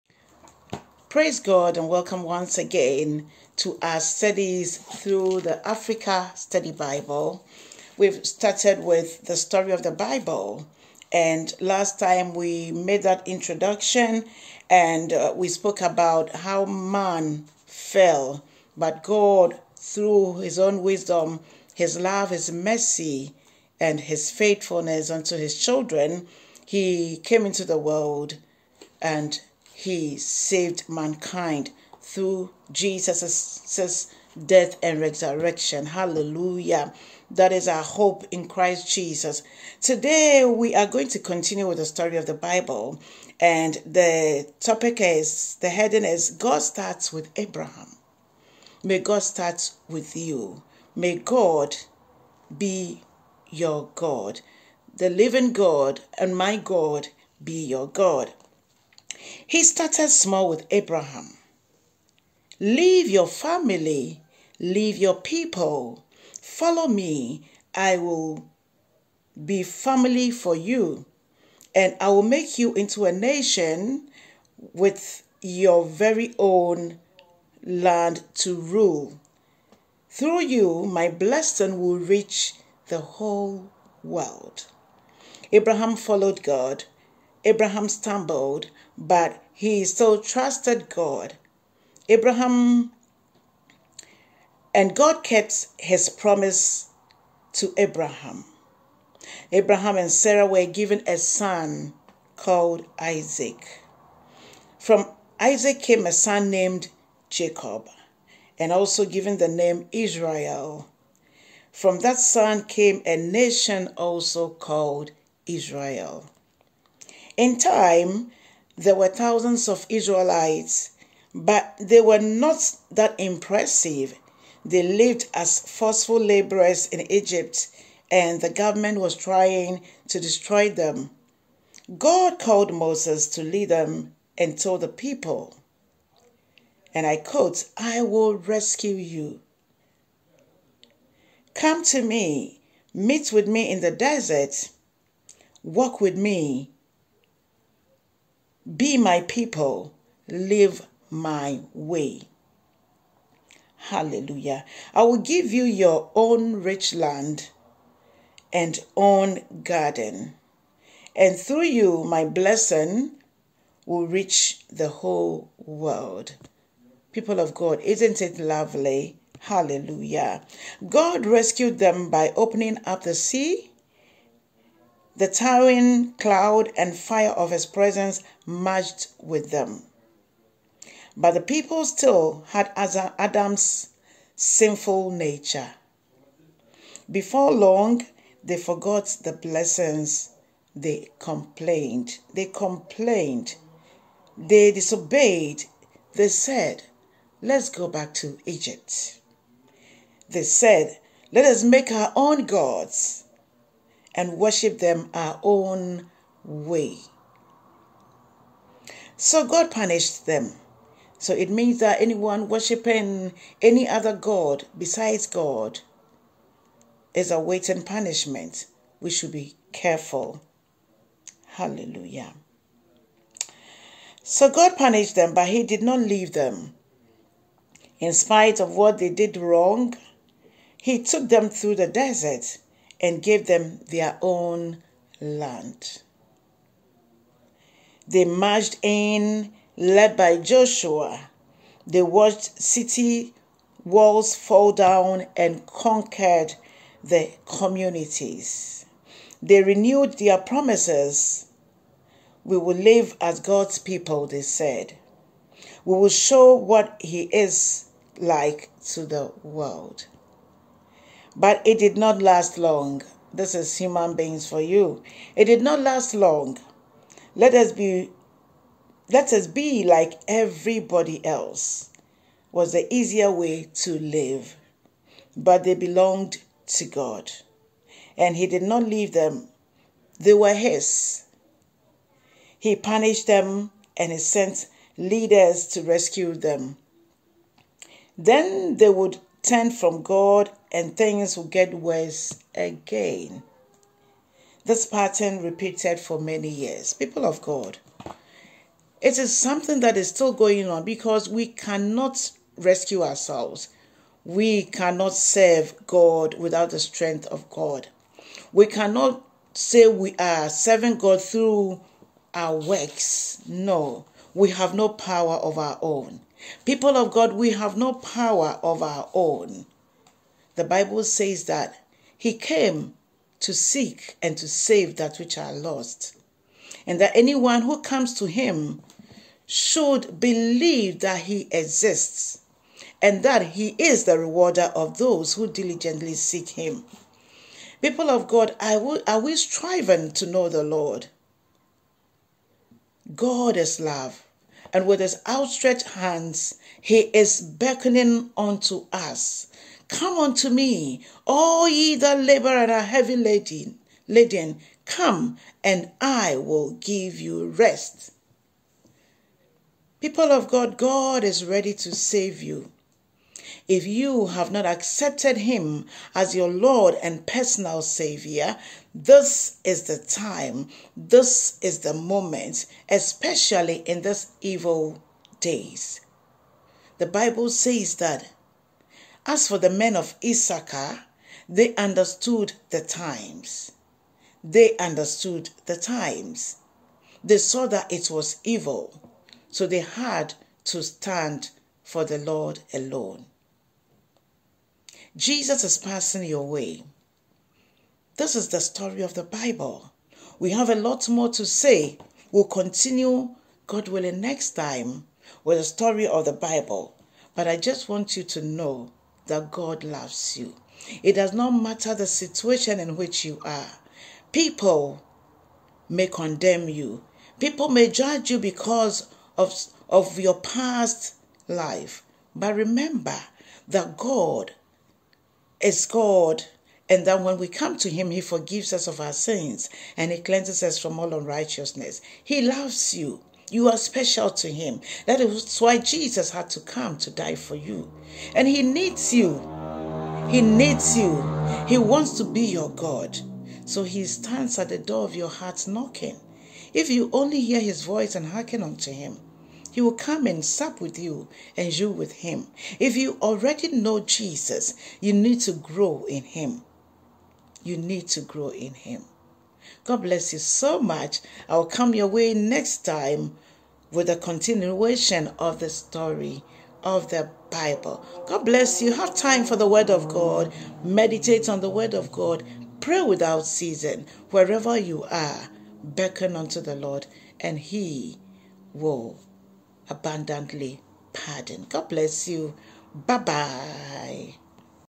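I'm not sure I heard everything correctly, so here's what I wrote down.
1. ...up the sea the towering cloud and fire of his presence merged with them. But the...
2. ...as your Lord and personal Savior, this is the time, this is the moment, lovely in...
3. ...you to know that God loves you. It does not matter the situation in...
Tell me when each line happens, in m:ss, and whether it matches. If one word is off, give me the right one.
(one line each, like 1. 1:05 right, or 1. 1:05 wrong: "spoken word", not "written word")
1. 2:52 right
2. 6:06 wrong: "especially", not "lovely"
3. 6:48 right.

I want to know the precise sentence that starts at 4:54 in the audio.
This pattern repeated for many years.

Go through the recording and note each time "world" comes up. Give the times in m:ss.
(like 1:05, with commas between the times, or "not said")
0:27, 1:24, 2:45, 4:19.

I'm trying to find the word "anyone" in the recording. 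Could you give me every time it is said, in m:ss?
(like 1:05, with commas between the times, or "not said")
3:32, 5:27.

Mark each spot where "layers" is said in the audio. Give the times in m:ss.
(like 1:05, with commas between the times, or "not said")
not said.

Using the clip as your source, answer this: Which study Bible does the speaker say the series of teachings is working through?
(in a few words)
Africa Study Bible.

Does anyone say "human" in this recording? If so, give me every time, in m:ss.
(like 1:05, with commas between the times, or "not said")
4:23.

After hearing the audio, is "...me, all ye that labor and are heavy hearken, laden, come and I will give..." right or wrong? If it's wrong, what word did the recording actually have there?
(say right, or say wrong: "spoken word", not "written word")
wrong: "laden", not "hearken".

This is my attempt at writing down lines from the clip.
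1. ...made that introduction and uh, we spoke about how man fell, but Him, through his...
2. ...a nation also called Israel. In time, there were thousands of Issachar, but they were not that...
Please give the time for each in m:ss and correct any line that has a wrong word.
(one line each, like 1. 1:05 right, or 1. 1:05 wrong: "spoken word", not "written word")
1. 0:12 wrong: "God", not "Him"
2. 1:53 wrong: "Israelites", not "Issachar".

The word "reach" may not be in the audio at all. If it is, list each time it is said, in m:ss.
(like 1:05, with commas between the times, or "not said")
1:21, 2:44.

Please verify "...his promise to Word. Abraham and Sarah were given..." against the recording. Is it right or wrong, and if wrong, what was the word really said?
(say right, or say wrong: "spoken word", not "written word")
wrong: "Abraham", not "Word".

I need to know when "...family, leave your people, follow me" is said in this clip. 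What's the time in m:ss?
1:03.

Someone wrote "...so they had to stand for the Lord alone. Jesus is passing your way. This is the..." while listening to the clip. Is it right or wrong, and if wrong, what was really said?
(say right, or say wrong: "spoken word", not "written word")
right.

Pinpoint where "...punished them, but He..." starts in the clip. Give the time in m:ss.
3:44.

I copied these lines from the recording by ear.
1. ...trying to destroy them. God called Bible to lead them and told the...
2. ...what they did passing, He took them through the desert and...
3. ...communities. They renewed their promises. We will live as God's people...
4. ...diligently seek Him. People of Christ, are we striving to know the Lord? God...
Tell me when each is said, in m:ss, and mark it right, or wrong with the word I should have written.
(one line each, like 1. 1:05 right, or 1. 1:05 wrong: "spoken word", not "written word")
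1. 2:09 wrong: "Moses", not "Bible"
2. 3:48 wrong: "wrong", not "passing"
3. 4:07 right
4. 5:35 wrong: "God", not "Christ".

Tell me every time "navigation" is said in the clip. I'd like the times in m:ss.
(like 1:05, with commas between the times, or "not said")
not said.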